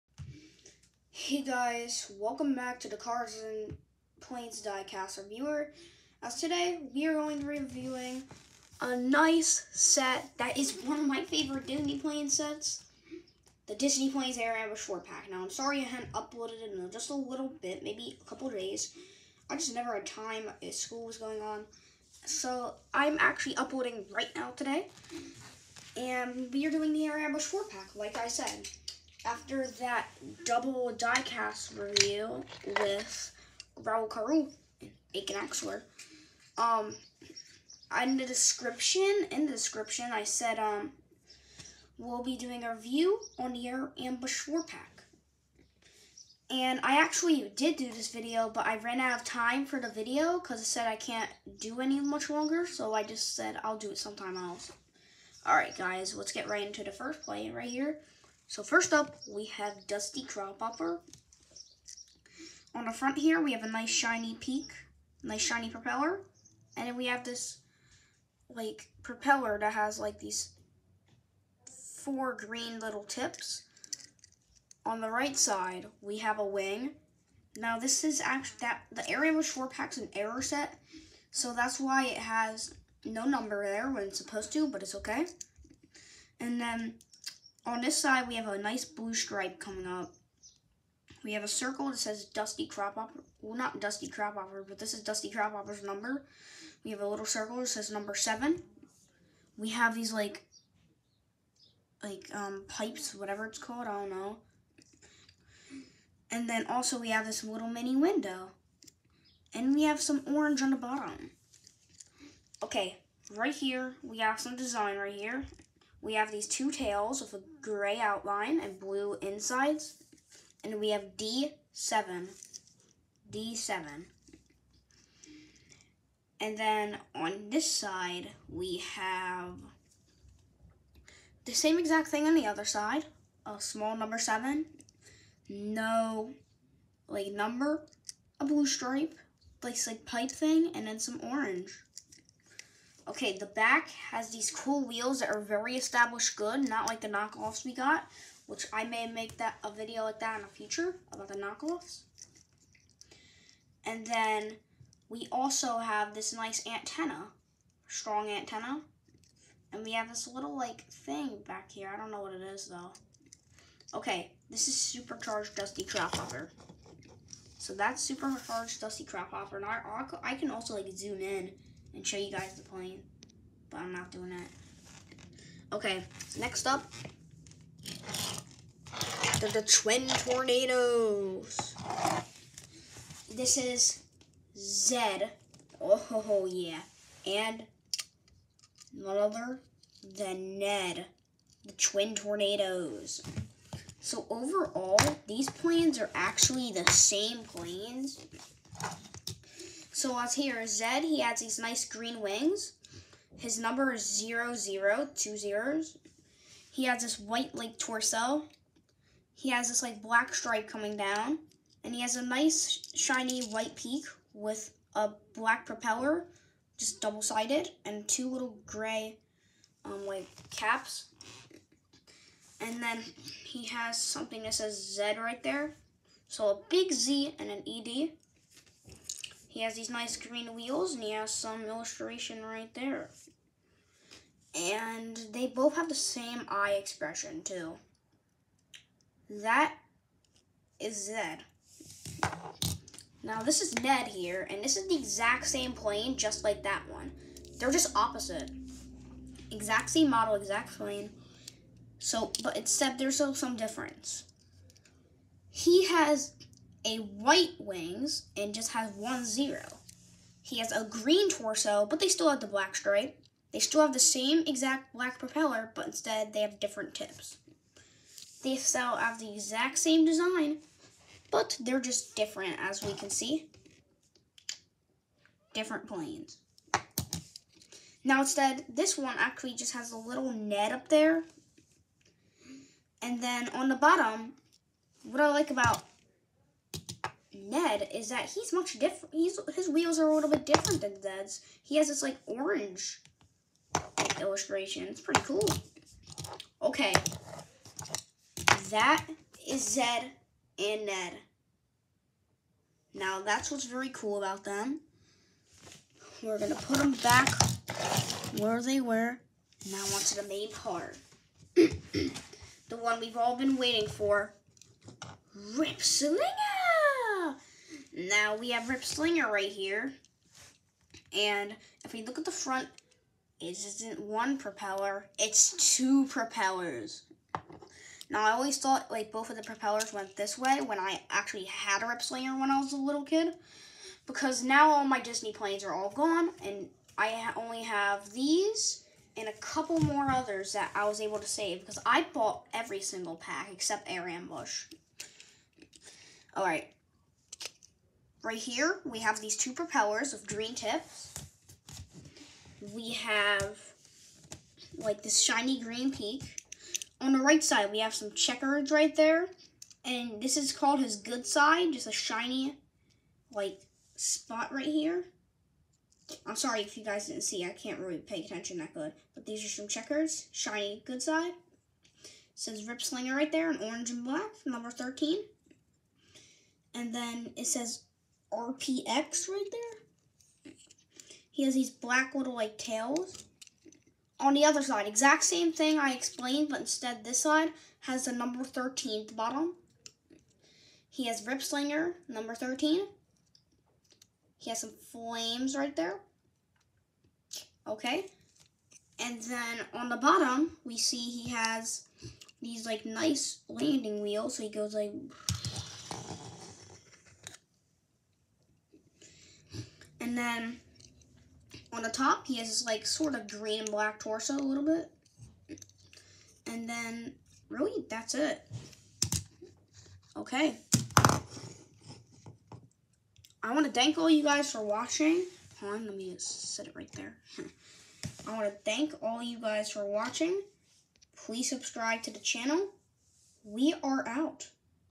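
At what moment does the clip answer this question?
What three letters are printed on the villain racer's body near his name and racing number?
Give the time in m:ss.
6:18.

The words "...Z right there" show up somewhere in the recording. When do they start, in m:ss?
3:44.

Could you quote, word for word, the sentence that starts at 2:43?
Okay, this is supercharged dusty Crophopper.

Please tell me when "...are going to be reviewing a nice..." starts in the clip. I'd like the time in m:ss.
0:07.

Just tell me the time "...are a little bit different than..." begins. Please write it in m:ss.
4:49.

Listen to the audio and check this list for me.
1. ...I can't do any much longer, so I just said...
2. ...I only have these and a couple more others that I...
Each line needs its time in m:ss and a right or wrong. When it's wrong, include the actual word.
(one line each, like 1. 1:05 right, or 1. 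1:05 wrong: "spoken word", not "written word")
1. 0:50 right
2. 5:36 right.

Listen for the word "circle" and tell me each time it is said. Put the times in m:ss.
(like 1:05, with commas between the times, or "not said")
1:31, 1:37.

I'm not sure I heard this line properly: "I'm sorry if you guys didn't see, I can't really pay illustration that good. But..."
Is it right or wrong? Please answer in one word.
wrong.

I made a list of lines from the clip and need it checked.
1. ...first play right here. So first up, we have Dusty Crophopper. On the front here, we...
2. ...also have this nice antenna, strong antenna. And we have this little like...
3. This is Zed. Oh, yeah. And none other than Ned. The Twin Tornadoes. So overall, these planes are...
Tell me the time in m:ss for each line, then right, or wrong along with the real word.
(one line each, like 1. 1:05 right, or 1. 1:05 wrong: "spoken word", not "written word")
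1. 0:56 right
2. 2:35 right
3. 3:03 right.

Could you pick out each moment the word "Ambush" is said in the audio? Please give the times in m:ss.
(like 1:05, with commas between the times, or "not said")
0:14, 0:27, 0:44, 5:44.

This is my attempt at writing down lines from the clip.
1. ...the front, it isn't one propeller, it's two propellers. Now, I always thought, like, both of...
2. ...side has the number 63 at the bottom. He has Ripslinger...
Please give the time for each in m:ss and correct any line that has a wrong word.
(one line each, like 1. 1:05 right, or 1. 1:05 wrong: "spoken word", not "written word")
1. 5:22 right
2. 6:27 wrong: "13", not "63".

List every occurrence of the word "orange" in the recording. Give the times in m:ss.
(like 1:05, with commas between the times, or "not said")
1:50, 2:21, 4:52, 6:13.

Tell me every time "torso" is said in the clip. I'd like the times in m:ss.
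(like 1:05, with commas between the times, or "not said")
3:27, 4:21, 6:54.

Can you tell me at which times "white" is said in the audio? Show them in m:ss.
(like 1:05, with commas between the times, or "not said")
3:27, 3:33, 4:16.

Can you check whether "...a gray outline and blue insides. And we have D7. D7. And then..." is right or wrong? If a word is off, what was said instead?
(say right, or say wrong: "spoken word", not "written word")
right.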